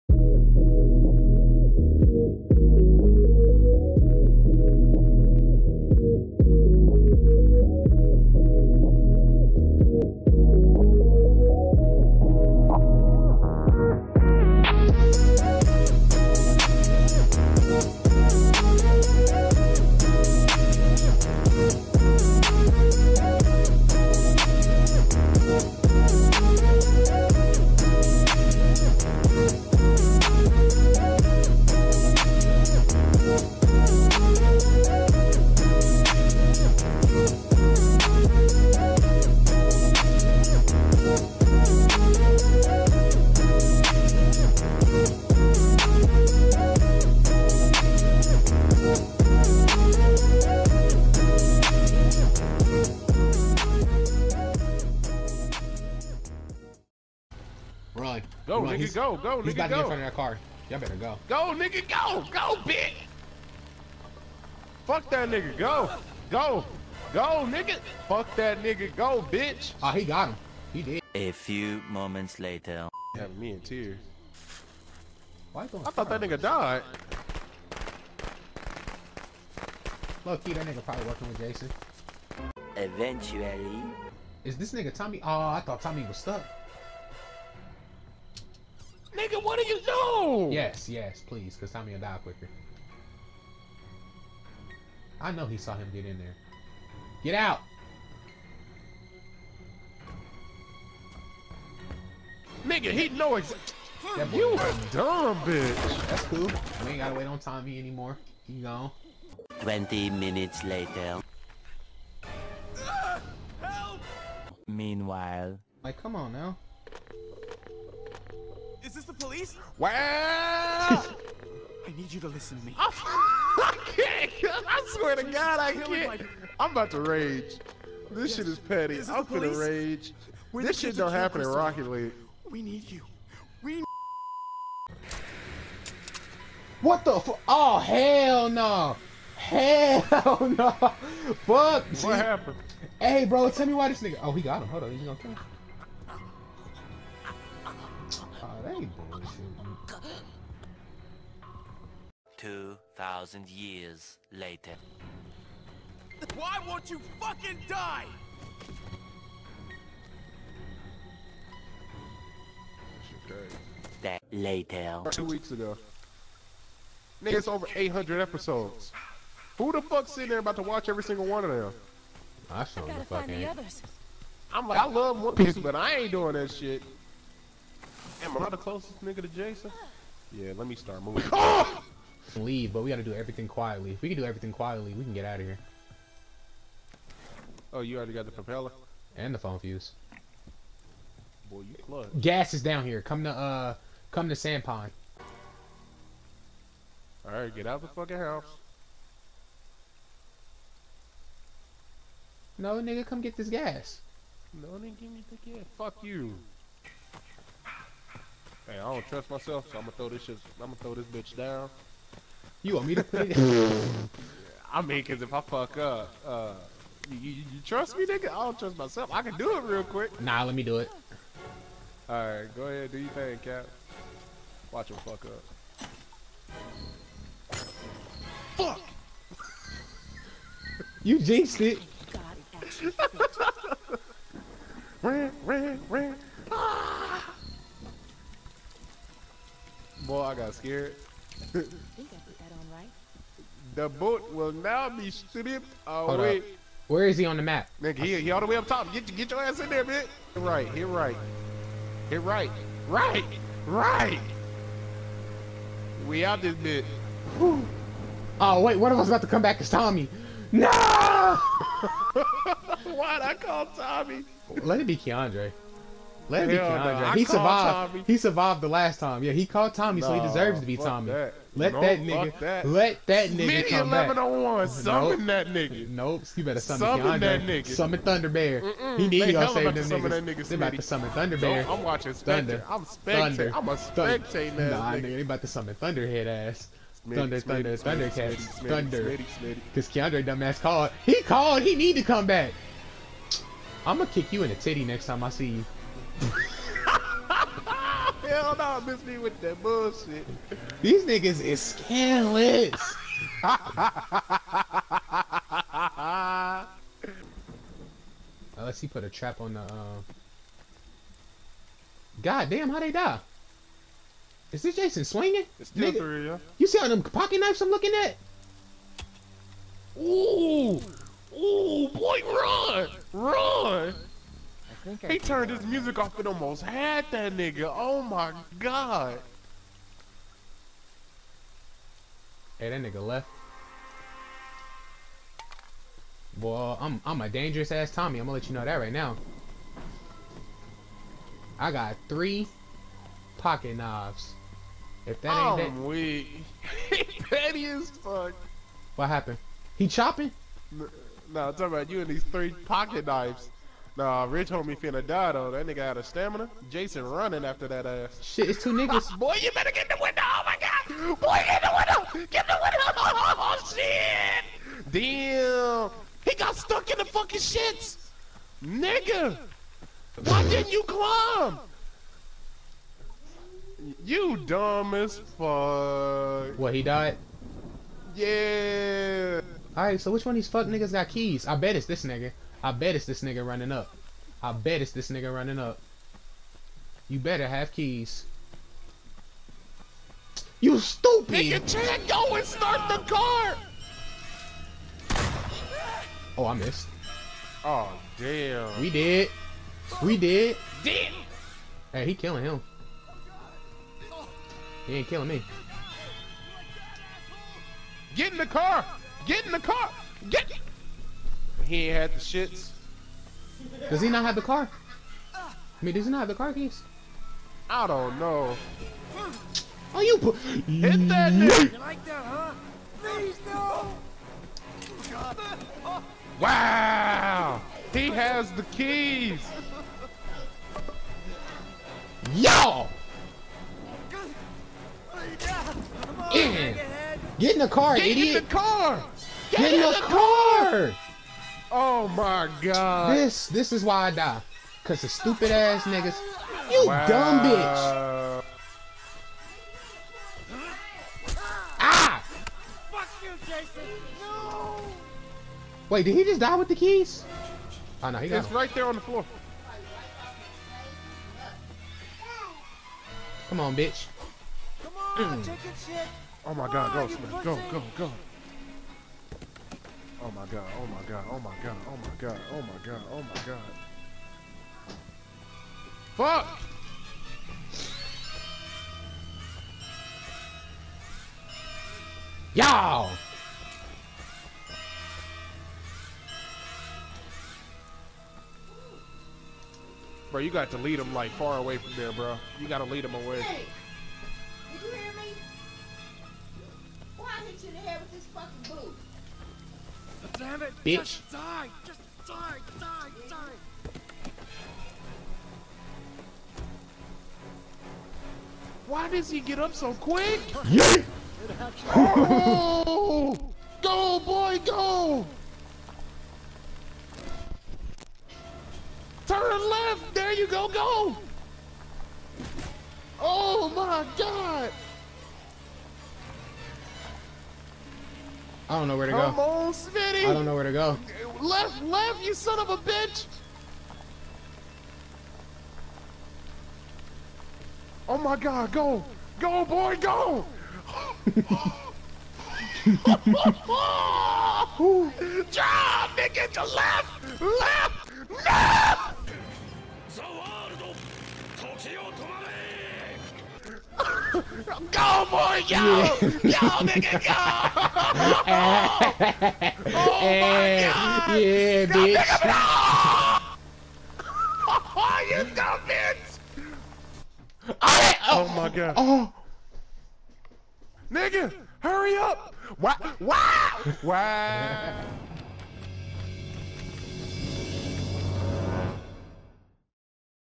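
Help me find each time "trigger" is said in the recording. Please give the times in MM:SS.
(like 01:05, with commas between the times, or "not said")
not said.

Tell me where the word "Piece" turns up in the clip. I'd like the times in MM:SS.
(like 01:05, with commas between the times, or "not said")
02:55.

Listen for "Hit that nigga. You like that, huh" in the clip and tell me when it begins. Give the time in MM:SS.
07:00.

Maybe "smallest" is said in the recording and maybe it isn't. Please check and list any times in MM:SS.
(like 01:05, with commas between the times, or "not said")
not said.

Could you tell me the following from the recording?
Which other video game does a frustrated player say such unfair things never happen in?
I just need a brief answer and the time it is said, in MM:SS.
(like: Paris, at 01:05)
Rocket League, at 02:11.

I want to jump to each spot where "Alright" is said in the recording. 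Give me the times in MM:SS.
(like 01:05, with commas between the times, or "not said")
03:17, 06:19.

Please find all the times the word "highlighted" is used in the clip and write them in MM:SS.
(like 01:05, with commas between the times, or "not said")
not said.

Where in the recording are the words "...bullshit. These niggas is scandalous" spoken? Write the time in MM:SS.
04:59.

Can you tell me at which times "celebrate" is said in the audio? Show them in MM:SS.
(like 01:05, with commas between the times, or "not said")
not said.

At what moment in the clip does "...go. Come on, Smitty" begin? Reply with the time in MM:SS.
08:49.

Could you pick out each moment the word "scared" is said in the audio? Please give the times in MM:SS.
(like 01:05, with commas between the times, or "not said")
04:00.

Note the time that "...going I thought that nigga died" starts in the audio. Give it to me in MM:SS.
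01:15.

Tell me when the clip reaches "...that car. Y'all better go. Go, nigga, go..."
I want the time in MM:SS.
00:59.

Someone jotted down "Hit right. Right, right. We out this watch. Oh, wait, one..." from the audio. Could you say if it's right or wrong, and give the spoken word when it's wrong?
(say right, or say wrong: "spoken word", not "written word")
wrong: "bitch", not "watch".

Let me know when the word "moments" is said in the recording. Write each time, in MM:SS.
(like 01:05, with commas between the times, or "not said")
01:11.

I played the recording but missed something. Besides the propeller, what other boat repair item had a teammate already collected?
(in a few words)
phone fuse.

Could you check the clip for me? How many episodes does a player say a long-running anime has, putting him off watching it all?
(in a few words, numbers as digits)
800.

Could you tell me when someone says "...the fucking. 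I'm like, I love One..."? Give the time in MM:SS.
02:52.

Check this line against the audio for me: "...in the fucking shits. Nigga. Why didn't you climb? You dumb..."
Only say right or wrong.
right.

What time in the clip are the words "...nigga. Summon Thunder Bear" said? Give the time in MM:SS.
04:37.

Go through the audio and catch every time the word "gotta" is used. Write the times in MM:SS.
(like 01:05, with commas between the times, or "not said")
01:46, 03:02.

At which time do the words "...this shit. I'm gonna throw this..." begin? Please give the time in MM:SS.
03:30.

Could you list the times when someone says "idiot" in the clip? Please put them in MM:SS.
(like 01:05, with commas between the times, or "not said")
07:18.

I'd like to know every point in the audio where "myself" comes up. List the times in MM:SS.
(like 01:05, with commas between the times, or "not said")
03:29, 03:38.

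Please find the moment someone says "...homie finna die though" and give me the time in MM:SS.
05:54.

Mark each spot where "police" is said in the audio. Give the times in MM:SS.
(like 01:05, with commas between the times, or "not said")
01:59.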